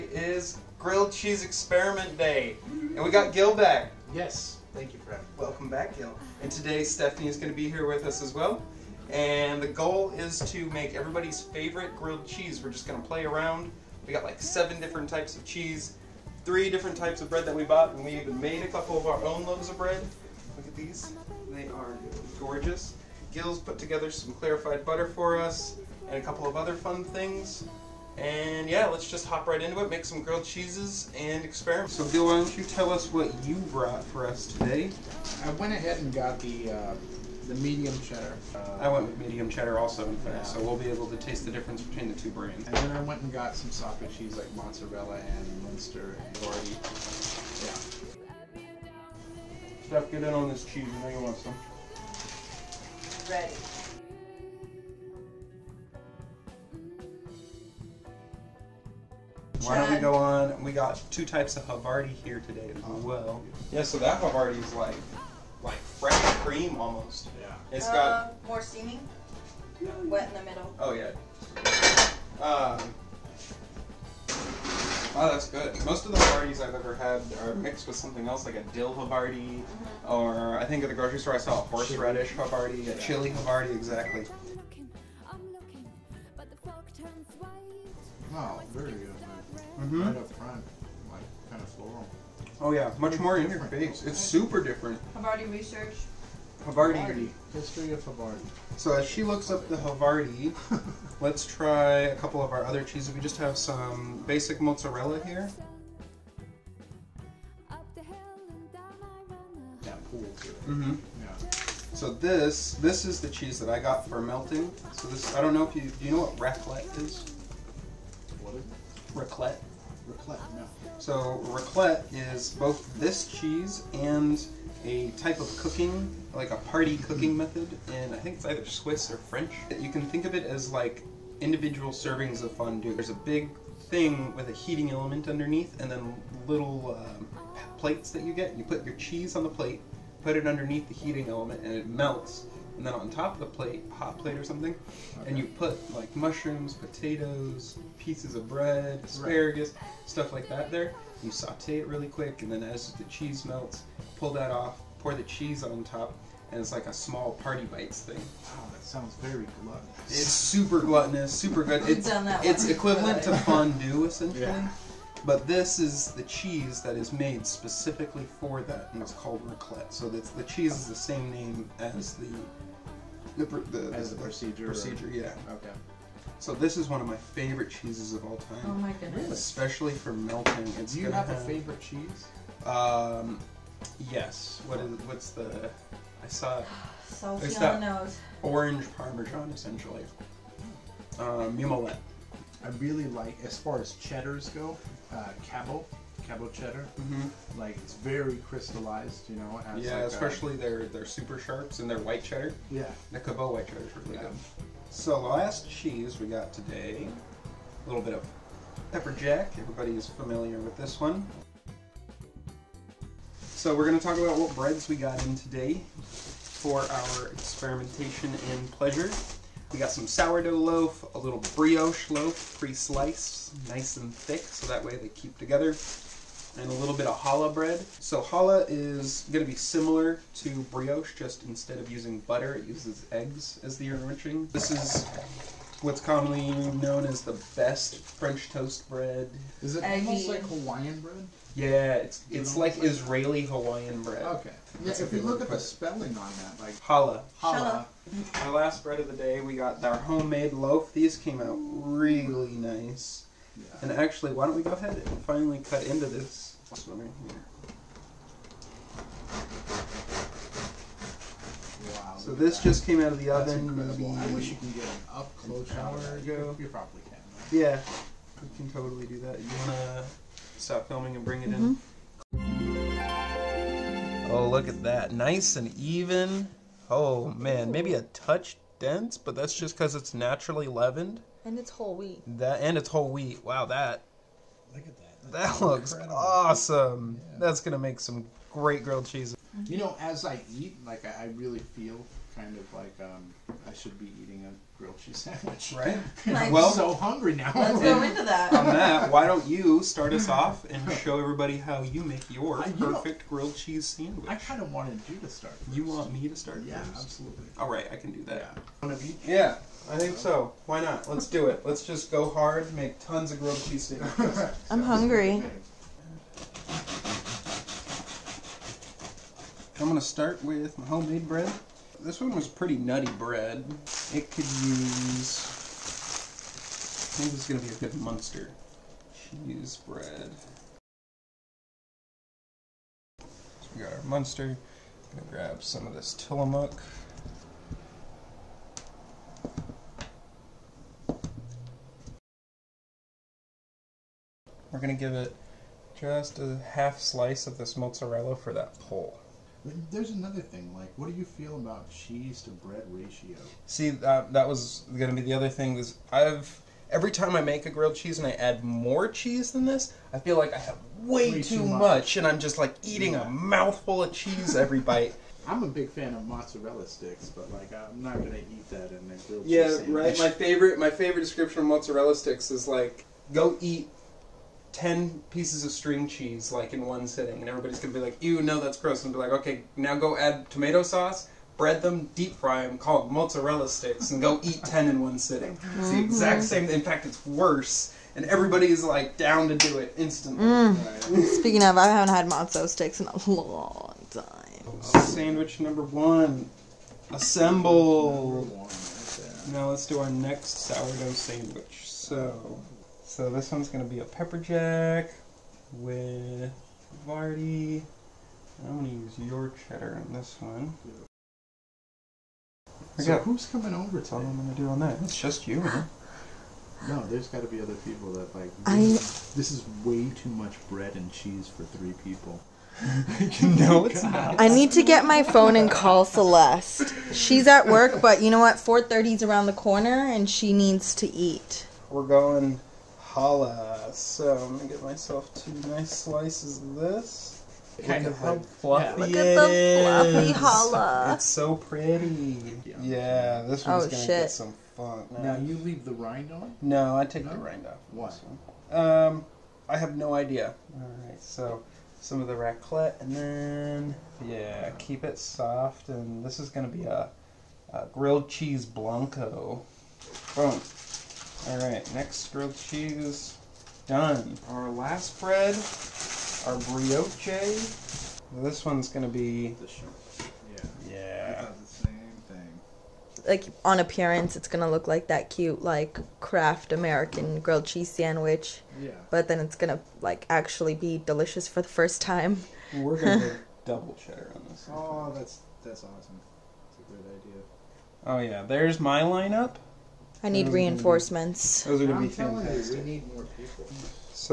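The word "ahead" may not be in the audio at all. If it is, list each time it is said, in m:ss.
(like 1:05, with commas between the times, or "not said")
0:35, 4:14.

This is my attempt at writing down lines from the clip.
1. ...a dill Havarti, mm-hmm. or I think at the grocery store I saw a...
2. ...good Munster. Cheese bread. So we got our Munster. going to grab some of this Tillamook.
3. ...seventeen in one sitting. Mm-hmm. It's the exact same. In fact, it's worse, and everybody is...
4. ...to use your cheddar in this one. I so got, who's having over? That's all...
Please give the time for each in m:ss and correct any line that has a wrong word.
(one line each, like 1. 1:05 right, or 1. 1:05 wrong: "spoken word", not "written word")
1. 1:18 right
2. 5:27 right
3. 6:24 wrong: "ten", not "seventeen"
4. 6:48 wrong: "coming", not "having".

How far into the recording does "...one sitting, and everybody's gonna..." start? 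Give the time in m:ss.
6:16.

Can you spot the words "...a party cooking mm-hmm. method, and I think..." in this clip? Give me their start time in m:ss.
2:06.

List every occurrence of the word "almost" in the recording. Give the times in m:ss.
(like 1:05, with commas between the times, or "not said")
1:06, 3:59.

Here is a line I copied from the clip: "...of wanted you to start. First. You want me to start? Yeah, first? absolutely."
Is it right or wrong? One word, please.
right.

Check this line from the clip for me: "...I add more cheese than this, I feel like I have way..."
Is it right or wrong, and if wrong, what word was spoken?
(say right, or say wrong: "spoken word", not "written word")
right.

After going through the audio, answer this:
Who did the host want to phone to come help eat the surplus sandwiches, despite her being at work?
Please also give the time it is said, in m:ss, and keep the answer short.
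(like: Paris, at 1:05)
Celeste, at 7:06.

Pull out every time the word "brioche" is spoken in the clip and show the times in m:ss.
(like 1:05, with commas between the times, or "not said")
3:41, 3:50, 7:46.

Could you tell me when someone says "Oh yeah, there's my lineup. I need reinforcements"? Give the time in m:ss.
8:08.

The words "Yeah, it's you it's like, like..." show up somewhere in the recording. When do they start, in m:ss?
4:01.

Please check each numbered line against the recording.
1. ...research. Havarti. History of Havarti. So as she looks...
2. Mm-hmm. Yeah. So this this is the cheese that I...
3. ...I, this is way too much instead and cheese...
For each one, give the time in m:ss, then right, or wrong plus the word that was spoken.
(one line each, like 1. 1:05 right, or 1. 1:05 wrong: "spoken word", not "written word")
1. 1:35 right
2. 1:50 right
3. 6:58 wrong: "bread", not "instead".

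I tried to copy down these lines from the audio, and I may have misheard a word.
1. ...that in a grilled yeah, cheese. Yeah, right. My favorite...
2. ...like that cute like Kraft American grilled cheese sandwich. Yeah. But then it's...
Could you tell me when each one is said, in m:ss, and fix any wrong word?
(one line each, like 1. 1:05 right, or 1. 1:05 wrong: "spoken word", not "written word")
1. 6:08 right
2. 7:54 right.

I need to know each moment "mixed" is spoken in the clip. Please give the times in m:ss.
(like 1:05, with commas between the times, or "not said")
1:17.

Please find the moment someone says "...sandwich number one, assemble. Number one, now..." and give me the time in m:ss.
6:35.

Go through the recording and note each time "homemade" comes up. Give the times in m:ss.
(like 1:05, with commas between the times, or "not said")
4:09, 5:20.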